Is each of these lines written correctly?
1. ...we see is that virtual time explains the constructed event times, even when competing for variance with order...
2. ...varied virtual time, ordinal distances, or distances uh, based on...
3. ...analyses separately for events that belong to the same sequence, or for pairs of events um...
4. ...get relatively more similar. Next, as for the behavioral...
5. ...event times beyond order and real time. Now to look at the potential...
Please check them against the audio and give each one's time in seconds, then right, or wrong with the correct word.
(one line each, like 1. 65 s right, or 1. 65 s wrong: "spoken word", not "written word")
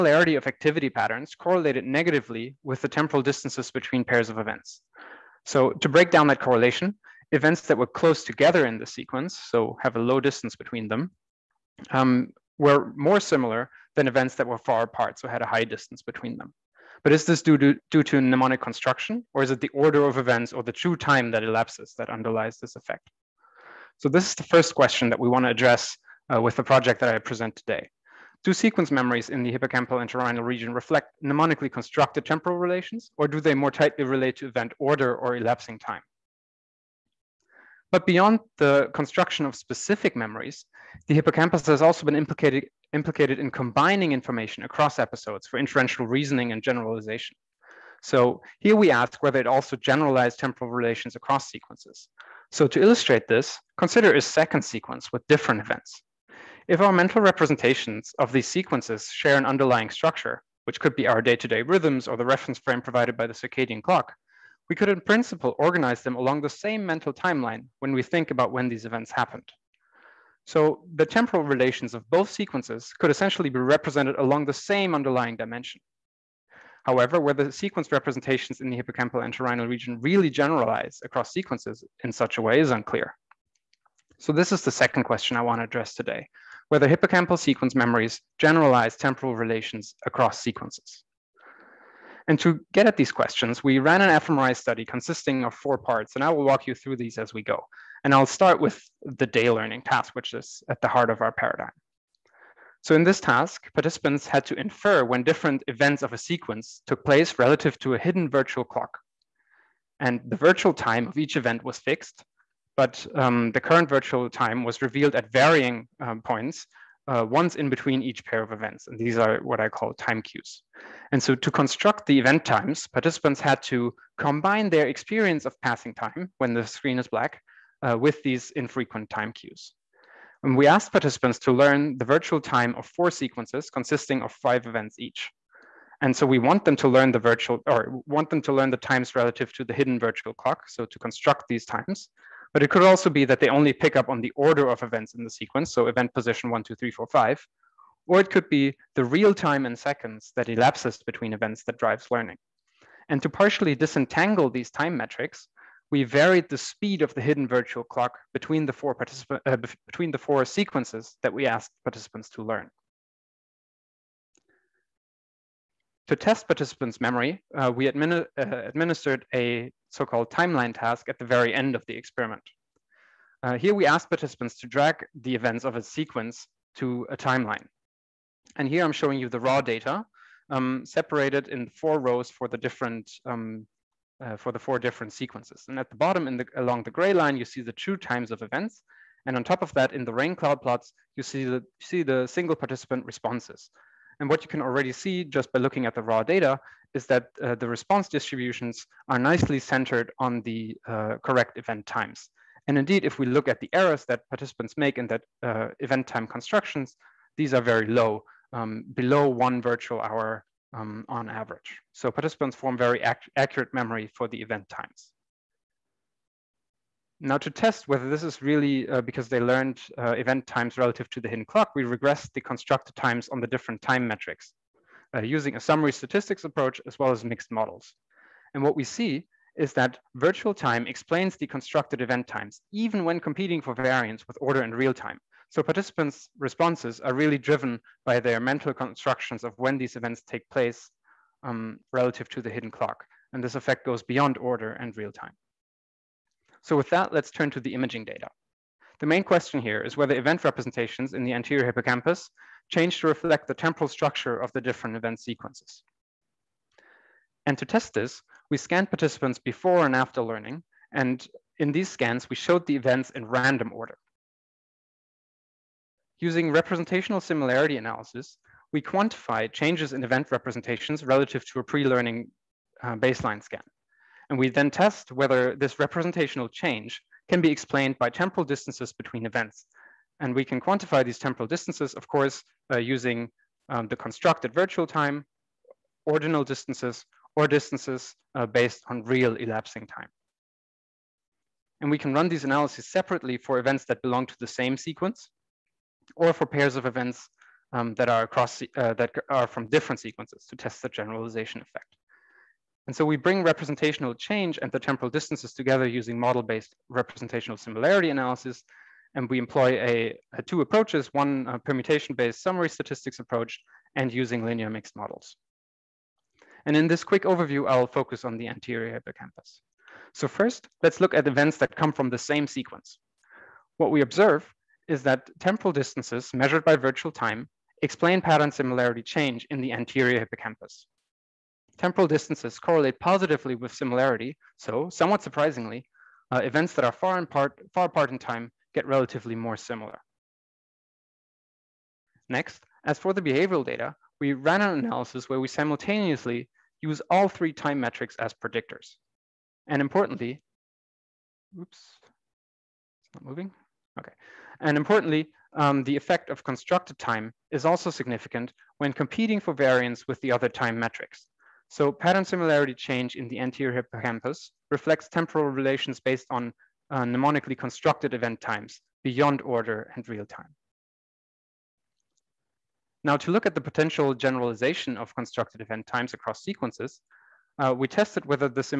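1. 228 s right
2. 283 s wrong: "constructed", not "varied"
3. 292 s right
4. 338 s right
5. 368 s right.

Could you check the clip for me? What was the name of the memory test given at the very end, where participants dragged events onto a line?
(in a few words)
timeline task.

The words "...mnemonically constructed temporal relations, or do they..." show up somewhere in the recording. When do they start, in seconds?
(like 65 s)
31 s.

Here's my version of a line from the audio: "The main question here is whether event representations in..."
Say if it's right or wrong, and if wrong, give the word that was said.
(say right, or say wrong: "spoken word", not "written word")
right.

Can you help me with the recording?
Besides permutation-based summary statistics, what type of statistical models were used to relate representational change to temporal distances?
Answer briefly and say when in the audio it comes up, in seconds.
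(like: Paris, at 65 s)
linear mixed models, at 314 s.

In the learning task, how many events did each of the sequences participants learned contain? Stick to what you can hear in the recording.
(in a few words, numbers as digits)
5.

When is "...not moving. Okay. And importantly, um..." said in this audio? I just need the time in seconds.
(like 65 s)
353 s.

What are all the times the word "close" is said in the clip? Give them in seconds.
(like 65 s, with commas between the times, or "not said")
7 s.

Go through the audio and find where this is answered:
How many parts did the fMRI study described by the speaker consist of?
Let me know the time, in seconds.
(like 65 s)
95 s.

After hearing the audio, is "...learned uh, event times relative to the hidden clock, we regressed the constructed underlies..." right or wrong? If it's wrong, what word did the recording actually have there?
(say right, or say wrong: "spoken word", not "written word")
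wrong: "times", not "underlies".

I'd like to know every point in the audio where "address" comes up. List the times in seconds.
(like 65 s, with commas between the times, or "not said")
25 s, 85 s.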